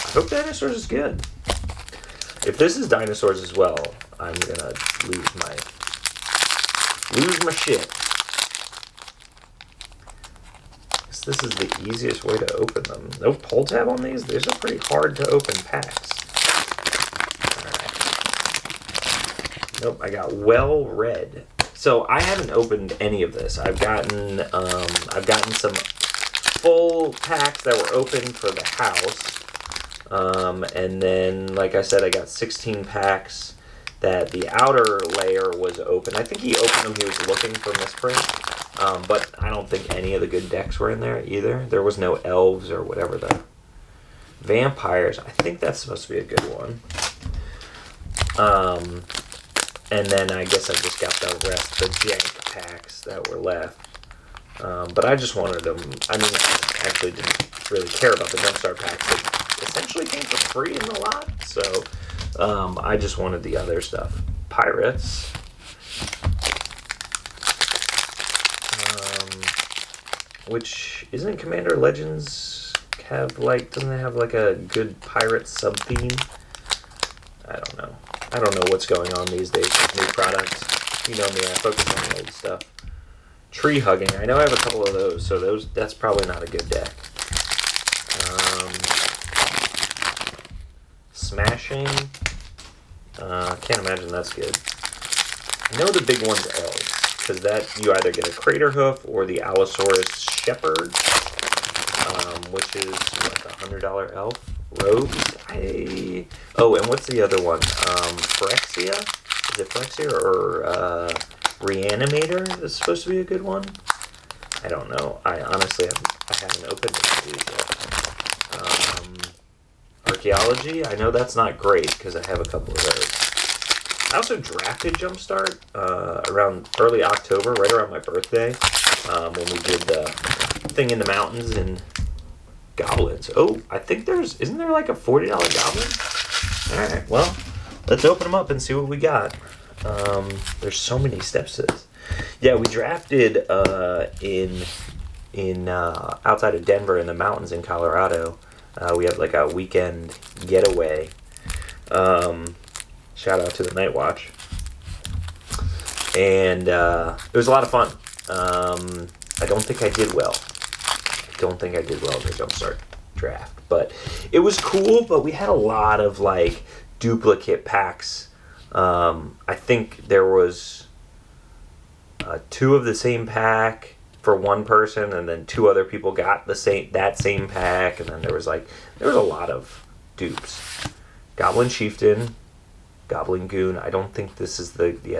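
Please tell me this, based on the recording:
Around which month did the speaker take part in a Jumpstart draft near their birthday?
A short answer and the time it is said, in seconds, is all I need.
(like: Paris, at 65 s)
October, at 127 s.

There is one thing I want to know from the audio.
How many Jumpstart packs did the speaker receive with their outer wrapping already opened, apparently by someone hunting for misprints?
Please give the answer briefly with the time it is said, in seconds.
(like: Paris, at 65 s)
16, at 32 s.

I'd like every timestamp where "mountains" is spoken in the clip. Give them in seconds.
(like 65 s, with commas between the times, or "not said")
131 s, 147 s.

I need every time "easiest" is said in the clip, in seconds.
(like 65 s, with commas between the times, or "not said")
11 s.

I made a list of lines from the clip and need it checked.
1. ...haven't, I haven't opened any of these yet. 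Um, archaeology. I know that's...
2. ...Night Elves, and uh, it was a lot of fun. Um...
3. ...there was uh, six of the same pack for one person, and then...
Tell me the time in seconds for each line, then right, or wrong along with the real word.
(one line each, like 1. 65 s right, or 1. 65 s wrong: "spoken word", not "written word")
1. 115 s right
2. 153 s wrong: "Watch", not "Elves"
3. 170 s wrong: "two", not "six".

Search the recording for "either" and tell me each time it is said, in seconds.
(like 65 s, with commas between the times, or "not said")
41 s, 97 s.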